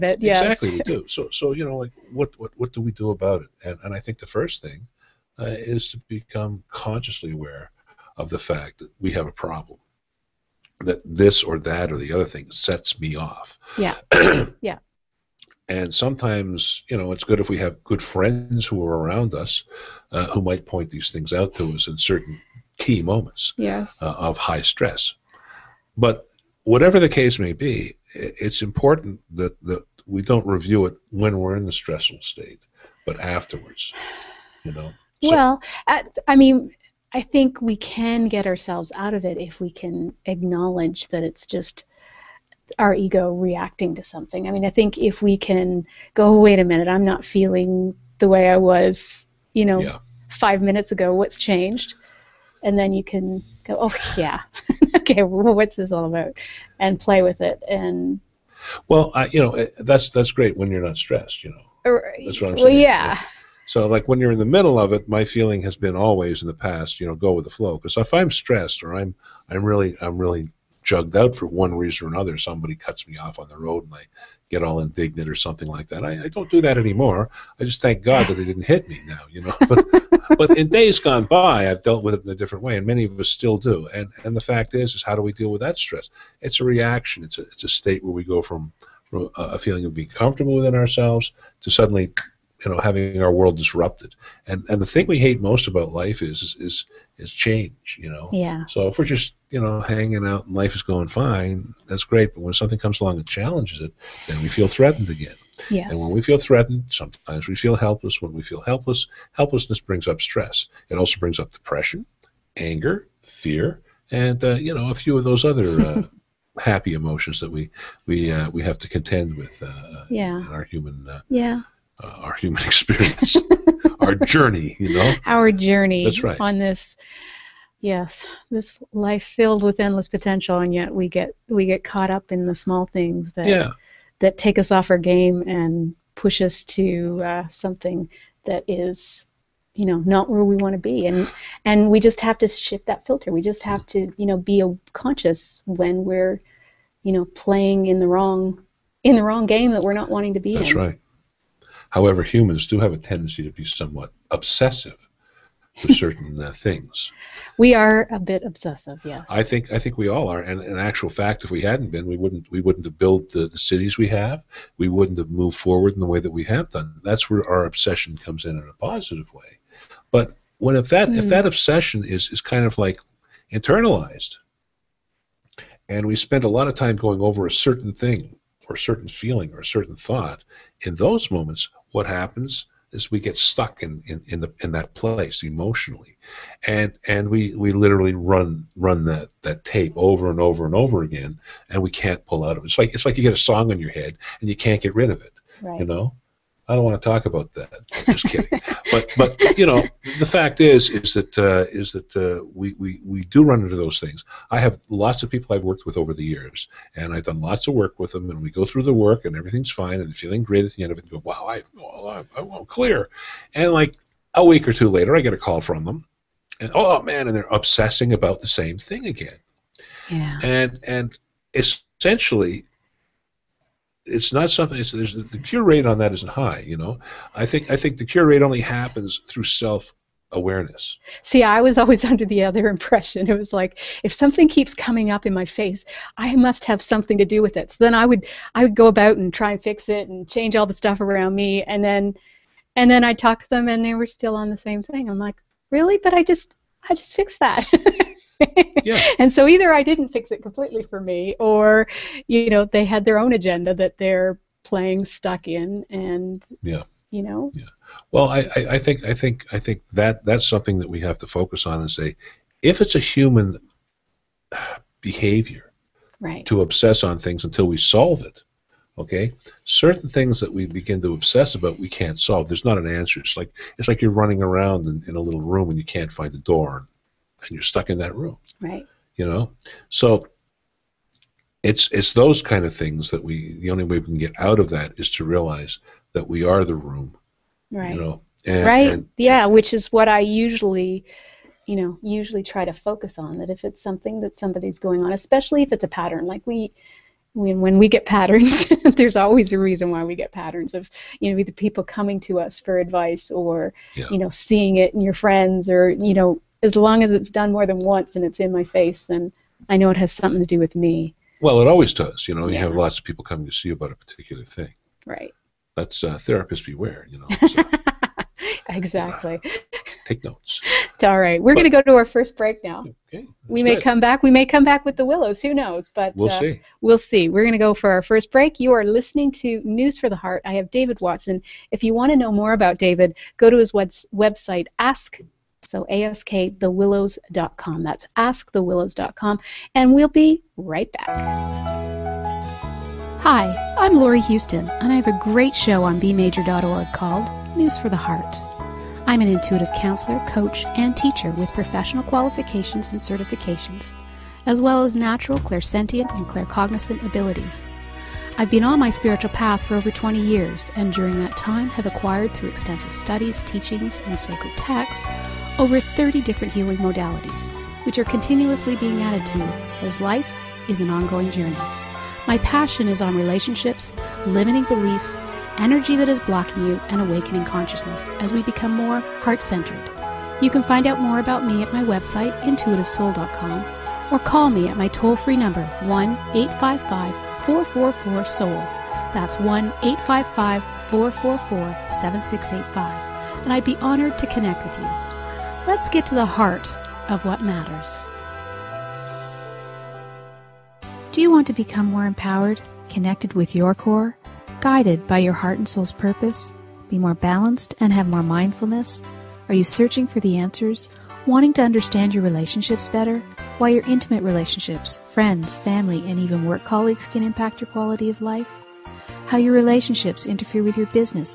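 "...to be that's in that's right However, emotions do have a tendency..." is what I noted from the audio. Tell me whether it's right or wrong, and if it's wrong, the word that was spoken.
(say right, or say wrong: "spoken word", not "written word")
wrong: "humans", not "emotions".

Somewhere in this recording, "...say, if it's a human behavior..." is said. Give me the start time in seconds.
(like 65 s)
261 s.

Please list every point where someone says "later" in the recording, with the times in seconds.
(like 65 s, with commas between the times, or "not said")
214 s.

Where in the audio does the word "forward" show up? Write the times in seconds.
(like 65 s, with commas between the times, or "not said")
165 s.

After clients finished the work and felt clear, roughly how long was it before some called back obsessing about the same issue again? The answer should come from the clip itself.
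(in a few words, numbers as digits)
a week or two.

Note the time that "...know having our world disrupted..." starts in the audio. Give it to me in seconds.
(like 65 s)
92 s.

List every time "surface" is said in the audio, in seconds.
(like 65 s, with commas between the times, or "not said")
not said.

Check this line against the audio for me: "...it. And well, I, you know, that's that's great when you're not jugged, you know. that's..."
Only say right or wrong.
wrong.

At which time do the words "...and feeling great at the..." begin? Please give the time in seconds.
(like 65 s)
209 s.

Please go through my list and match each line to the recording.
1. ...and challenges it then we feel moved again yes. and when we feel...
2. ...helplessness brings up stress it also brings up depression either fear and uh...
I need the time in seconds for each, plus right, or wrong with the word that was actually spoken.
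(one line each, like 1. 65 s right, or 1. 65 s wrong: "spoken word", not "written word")
1. 103 s wrong: "threatened", not "moved"
2. 109 s wrong: "anger", not "either".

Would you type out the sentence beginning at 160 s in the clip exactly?
And in actual fact, if we hadn't been, we wouldn't we wouldn't have built the, the cities we have.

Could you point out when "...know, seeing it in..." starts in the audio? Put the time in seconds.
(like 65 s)
304 s.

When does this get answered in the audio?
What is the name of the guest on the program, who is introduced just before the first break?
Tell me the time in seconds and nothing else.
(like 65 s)
330 s.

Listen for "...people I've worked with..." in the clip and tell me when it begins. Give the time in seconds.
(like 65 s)
205 s.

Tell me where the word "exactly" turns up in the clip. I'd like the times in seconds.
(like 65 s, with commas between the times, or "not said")
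0 s, 318 s.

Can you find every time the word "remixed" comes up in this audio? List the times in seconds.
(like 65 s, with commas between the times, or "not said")
not said.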